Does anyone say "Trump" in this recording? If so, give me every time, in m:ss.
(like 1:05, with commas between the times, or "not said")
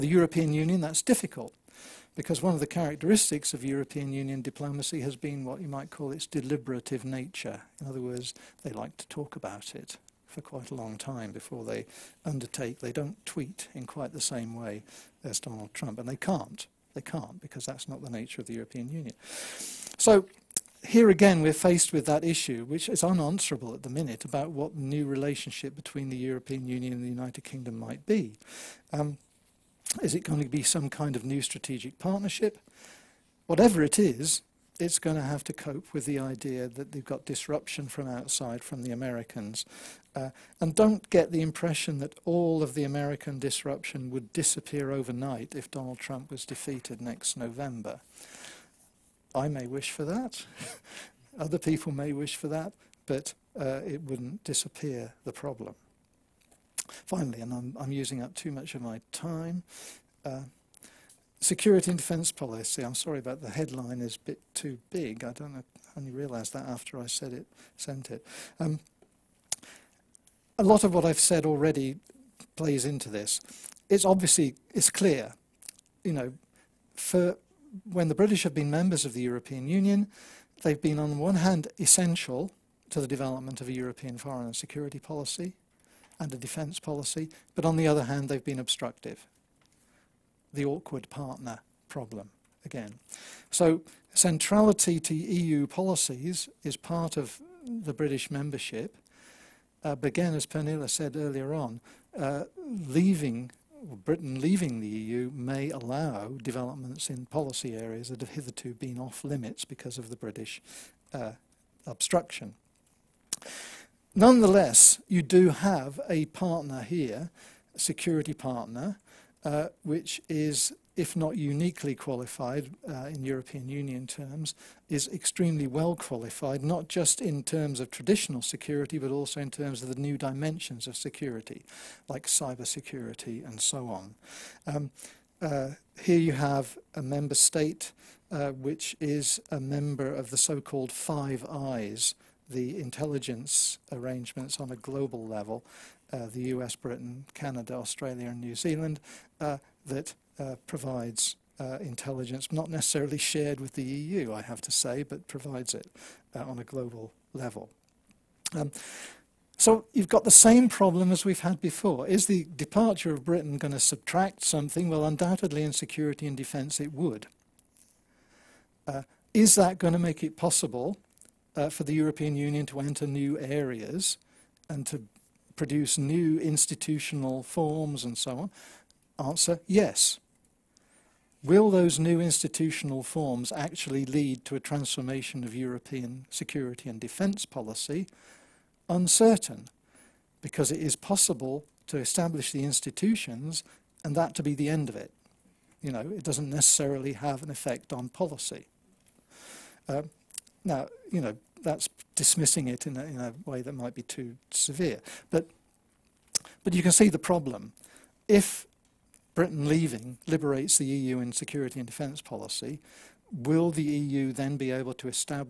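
0:15, 0:45.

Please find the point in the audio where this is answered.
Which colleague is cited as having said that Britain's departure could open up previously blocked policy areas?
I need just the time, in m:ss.
1:40.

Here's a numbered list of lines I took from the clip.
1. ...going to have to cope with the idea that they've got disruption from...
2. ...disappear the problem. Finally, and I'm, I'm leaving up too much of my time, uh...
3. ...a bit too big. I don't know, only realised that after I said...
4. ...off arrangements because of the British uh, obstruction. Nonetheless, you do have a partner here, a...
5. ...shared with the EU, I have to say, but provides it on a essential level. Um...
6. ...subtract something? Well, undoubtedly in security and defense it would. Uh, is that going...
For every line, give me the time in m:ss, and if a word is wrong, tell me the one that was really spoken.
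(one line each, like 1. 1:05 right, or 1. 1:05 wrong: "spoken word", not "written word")
1. 0:34 right
2. 0:54 wrong: "using", not "leaving"
3. 1:04 right
4. 1:48 wrong: "limits", not "arrangements"
5. 2:33 wrong: "global", not "essential"
6. 2:43 right.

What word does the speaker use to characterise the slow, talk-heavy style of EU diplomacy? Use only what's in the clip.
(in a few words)
Deliberative.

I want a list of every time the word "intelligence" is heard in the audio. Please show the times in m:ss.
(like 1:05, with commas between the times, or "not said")
2:22, 2:31.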